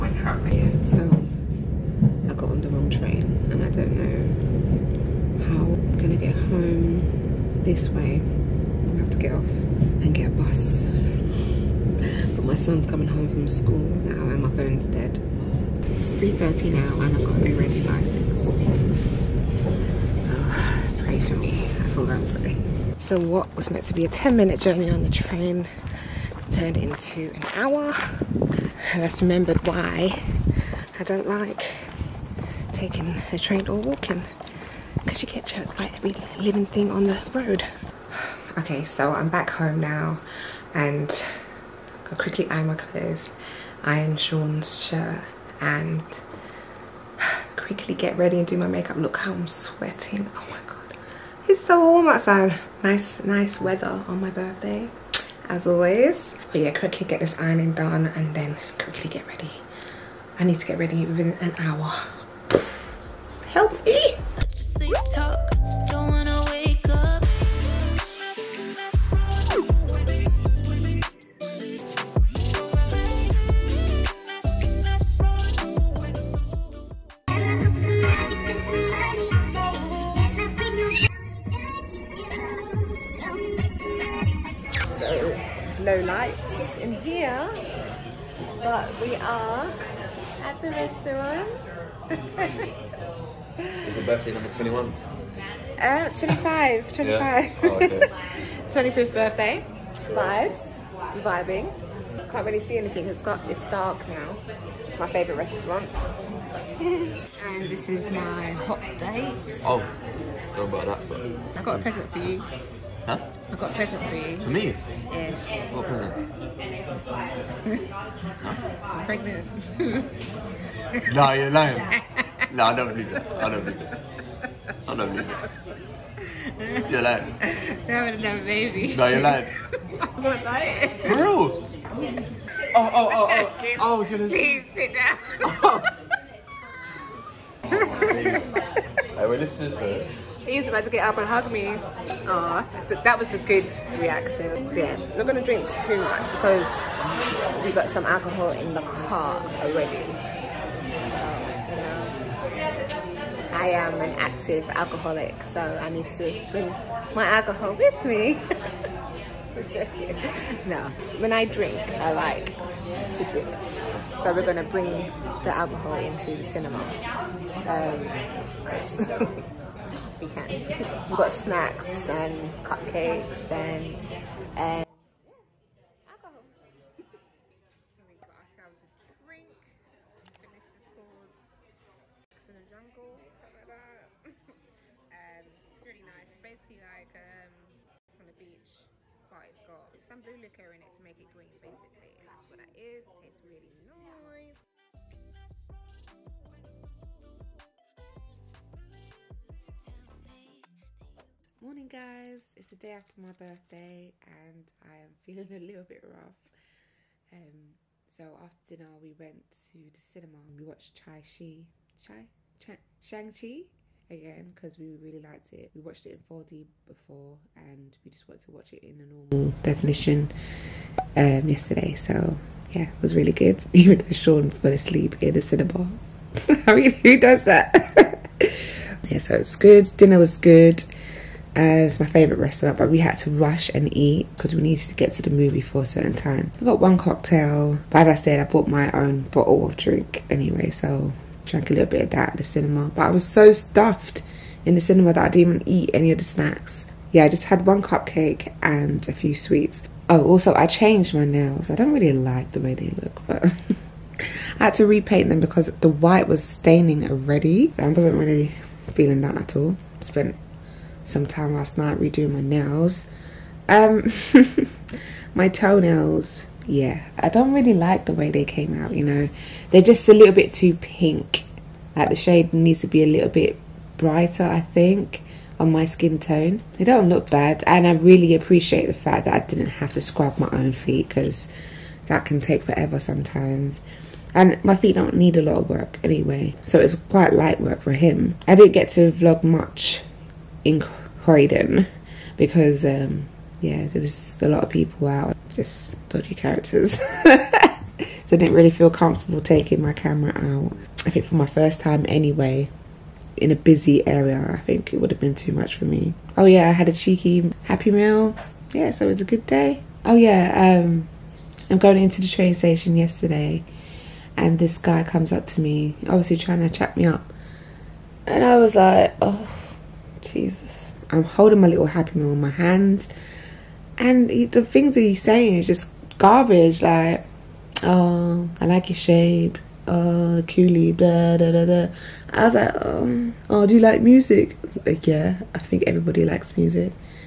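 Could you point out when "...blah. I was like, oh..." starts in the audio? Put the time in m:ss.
5:31.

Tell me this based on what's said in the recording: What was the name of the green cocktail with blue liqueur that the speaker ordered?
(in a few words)
Sex in the Jungle.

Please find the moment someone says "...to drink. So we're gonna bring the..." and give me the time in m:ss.
2:43.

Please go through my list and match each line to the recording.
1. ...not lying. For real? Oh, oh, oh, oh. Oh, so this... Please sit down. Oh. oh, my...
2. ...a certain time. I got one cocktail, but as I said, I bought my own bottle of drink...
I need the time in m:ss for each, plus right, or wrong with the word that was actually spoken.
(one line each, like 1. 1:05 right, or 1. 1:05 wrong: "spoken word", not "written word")
1. 2:10 right
2. 3:55 right.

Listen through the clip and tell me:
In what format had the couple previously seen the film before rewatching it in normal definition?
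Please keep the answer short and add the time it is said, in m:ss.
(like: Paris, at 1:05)
4D, at 3:36.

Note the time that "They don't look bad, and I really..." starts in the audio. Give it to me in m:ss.
4:36.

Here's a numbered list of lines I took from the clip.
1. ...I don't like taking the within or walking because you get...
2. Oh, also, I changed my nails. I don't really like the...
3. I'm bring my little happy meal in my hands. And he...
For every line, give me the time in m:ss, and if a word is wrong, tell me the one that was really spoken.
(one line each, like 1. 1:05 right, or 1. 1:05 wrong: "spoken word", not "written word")
1. 0:30 wrong: "train", not "within"
2. 4:10 right
3. 5:21 wrong: "holding", not "bring".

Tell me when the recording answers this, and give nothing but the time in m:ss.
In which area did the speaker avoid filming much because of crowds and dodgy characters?
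4:51.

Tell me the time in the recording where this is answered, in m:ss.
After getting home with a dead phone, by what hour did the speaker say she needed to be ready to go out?
0:17.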